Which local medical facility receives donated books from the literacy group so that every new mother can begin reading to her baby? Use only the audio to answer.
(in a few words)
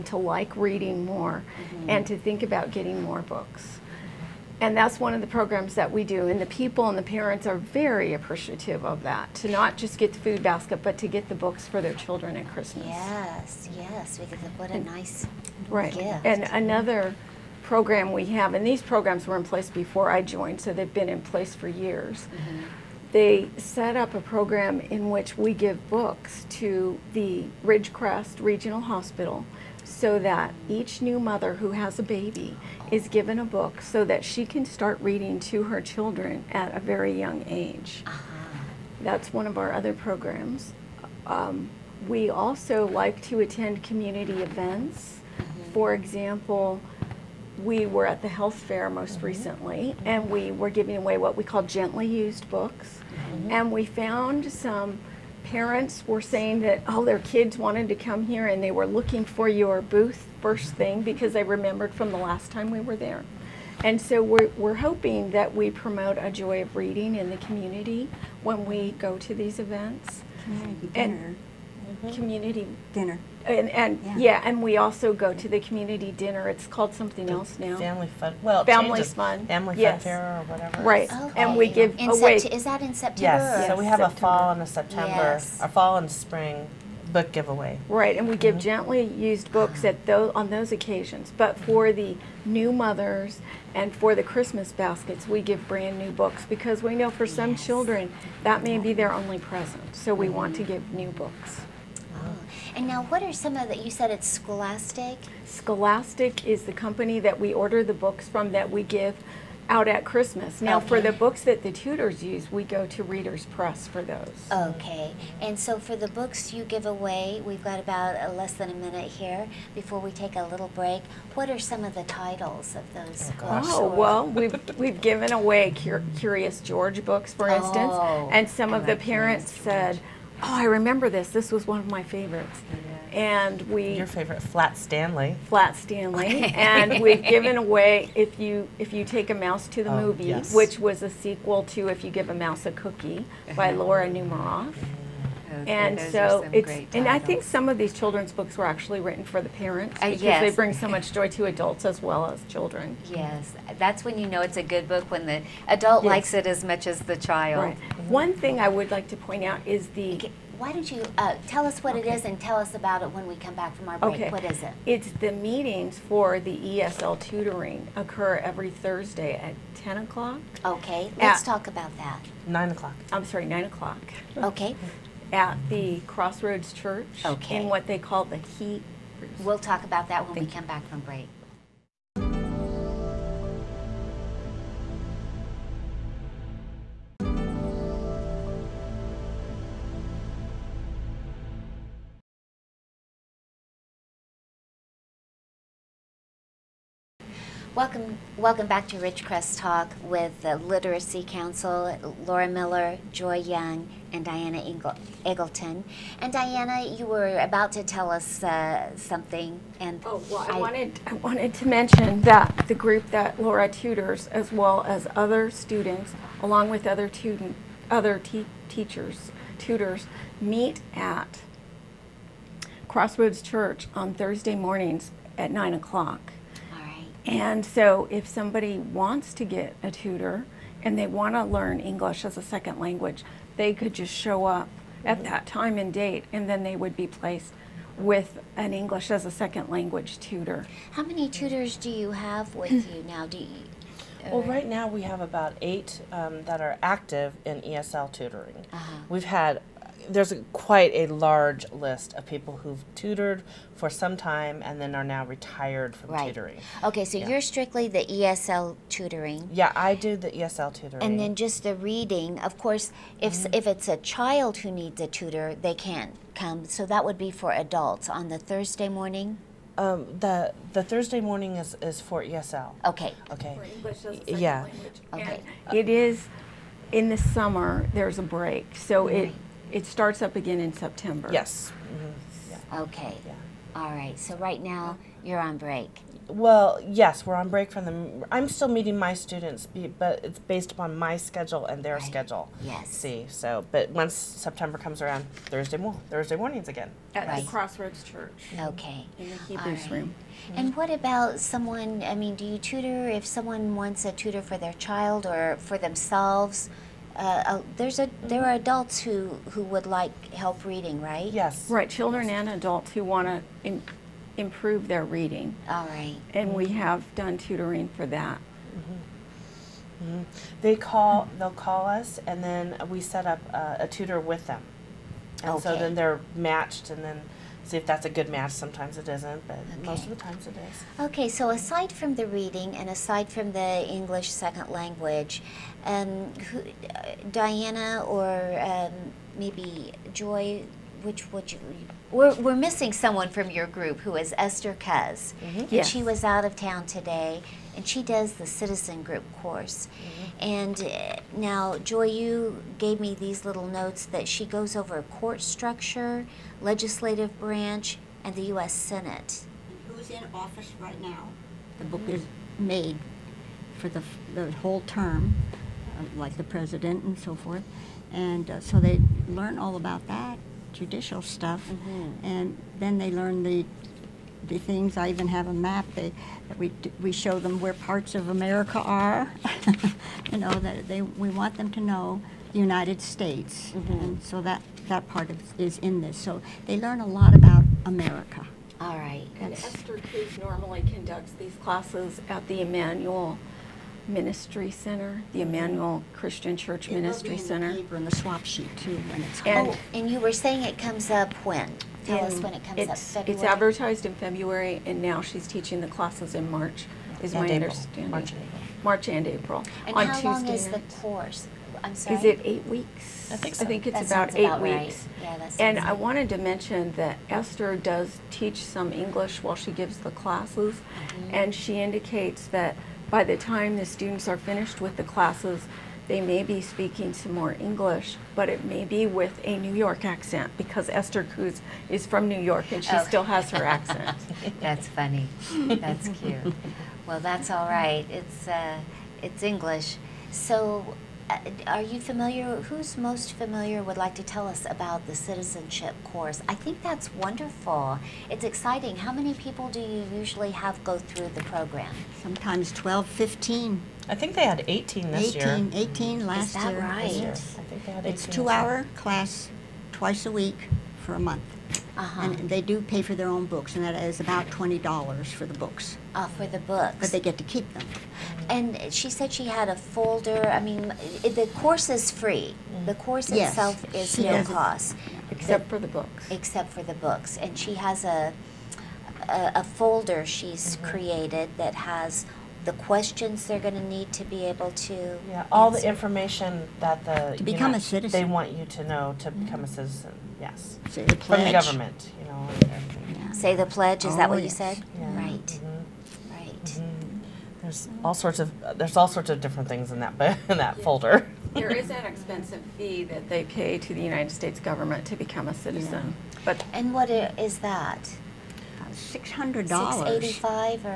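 Ridgecrest Regional Hospital.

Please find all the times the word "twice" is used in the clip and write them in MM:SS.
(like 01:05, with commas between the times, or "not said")
07:39.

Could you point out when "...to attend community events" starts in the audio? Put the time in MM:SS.
00:43.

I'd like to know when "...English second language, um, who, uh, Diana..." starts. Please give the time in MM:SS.
05:33.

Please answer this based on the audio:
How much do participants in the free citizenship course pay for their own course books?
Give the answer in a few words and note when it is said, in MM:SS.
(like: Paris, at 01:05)
$20, at 07:44.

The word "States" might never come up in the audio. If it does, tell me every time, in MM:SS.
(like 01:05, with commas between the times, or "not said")
06:23, 08:24.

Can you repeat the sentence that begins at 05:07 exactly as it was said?
Uh, uh, there's a there are adults who who would like help reading, right?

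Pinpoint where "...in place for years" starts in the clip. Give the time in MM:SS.
00:21.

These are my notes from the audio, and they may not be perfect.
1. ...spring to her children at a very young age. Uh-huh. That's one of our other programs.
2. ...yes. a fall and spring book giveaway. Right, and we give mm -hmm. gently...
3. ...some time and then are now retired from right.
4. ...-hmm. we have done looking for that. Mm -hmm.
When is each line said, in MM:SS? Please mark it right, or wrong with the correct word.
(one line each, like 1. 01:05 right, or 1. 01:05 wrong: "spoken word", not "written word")
1. 00:35 wrong: "reading", not "spring"
2. 01:25 right
3. 04:13 right
4. 05:16 wrong: "tutoring", not "looking".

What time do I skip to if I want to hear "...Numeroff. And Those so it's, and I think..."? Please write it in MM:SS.
02:24.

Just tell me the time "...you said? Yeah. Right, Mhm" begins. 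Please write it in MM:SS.
08:14.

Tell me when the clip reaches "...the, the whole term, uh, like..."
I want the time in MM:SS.
06:03.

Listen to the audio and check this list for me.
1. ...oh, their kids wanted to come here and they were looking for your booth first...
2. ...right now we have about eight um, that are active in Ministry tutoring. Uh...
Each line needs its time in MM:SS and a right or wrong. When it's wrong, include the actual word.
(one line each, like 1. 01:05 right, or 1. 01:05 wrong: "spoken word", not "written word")
1. 00:57 right
2. 04:04 wrong: "ESL", not "Ministry".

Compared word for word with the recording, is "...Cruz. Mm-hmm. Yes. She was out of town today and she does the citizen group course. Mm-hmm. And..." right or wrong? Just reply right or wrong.
right.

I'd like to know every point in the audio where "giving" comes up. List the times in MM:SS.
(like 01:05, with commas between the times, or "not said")
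00:50.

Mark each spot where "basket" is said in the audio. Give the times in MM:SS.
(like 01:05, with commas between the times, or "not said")
00:10, 01:34.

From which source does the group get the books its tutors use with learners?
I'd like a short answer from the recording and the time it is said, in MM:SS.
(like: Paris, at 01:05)
Reader's Press, at 01:53.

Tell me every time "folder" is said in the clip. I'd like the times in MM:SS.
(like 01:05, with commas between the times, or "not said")
07:49, 07:59, 08:20.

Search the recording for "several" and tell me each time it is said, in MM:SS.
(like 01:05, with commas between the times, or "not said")
not said.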